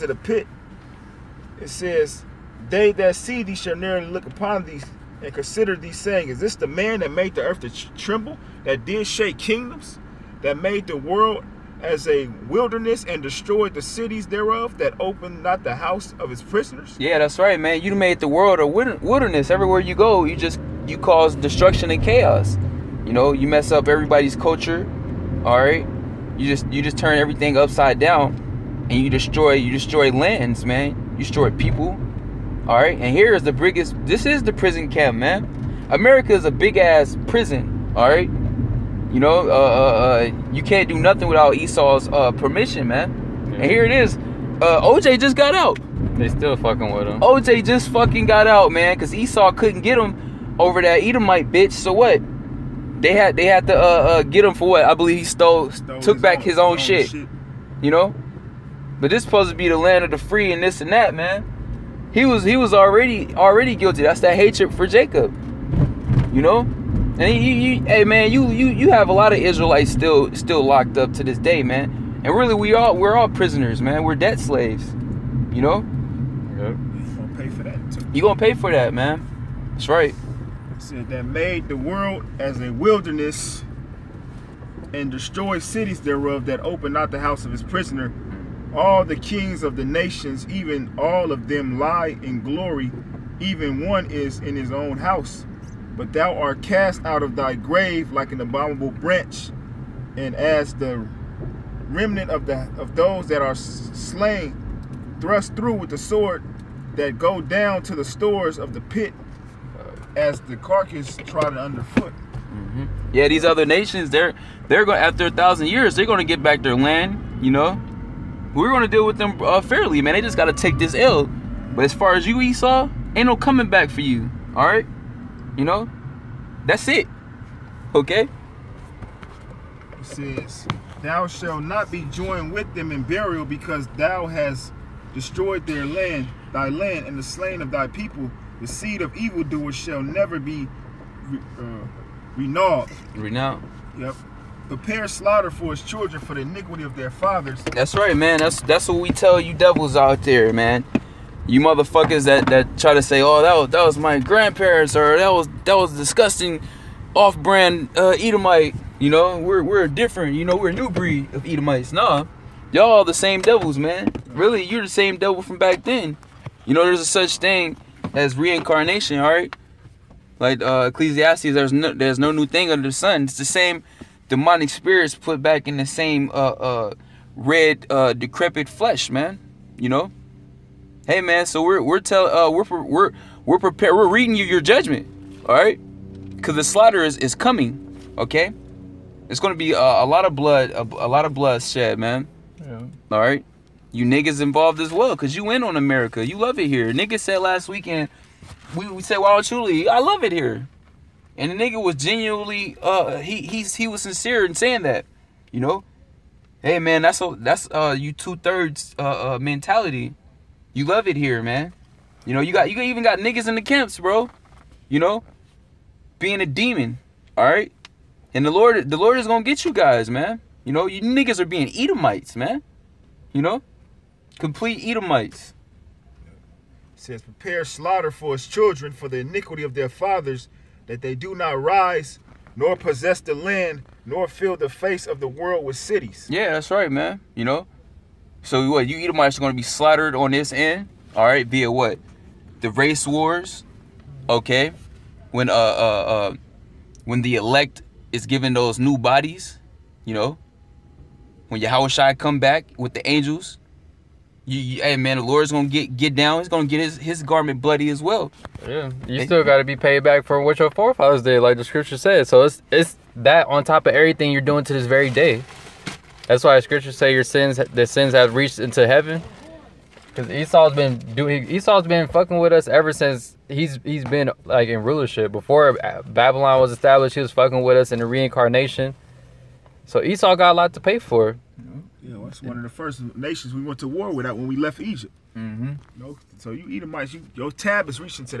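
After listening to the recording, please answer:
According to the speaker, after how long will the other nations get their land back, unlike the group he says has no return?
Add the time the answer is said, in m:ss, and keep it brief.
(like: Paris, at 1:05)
1000 years, at 1:55.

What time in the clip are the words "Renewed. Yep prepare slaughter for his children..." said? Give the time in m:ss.
2:23.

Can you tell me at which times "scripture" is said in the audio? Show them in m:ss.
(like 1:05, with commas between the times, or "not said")
4:21, 4:26.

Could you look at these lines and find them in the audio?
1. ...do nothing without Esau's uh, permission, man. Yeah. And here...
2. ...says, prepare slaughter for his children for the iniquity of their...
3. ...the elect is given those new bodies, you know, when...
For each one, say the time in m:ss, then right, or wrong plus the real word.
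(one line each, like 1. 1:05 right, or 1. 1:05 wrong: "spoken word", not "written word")
1. 0:40 right
2. 3:46 right
3. 4:07 right.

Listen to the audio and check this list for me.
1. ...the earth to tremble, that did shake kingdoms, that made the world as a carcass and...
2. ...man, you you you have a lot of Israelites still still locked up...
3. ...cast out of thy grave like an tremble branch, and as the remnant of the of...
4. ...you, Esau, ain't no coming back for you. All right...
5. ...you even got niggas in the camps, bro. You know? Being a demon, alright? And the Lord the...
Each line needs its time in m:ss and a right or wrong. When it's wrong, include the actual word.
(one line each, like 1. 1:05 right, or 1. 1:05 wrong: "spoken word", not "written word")
1. 0:07 wrong: "wilderness", not "carcass"
2. 1:08 right
3. 1:36 wrong: "abominable", not "tremble"
4. 2:02 right
5. 3:32 right.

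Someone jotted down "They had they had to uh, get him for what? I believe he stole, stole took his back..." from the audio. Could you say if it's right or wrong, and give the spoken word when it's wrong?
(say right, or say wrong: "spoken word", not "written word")
right.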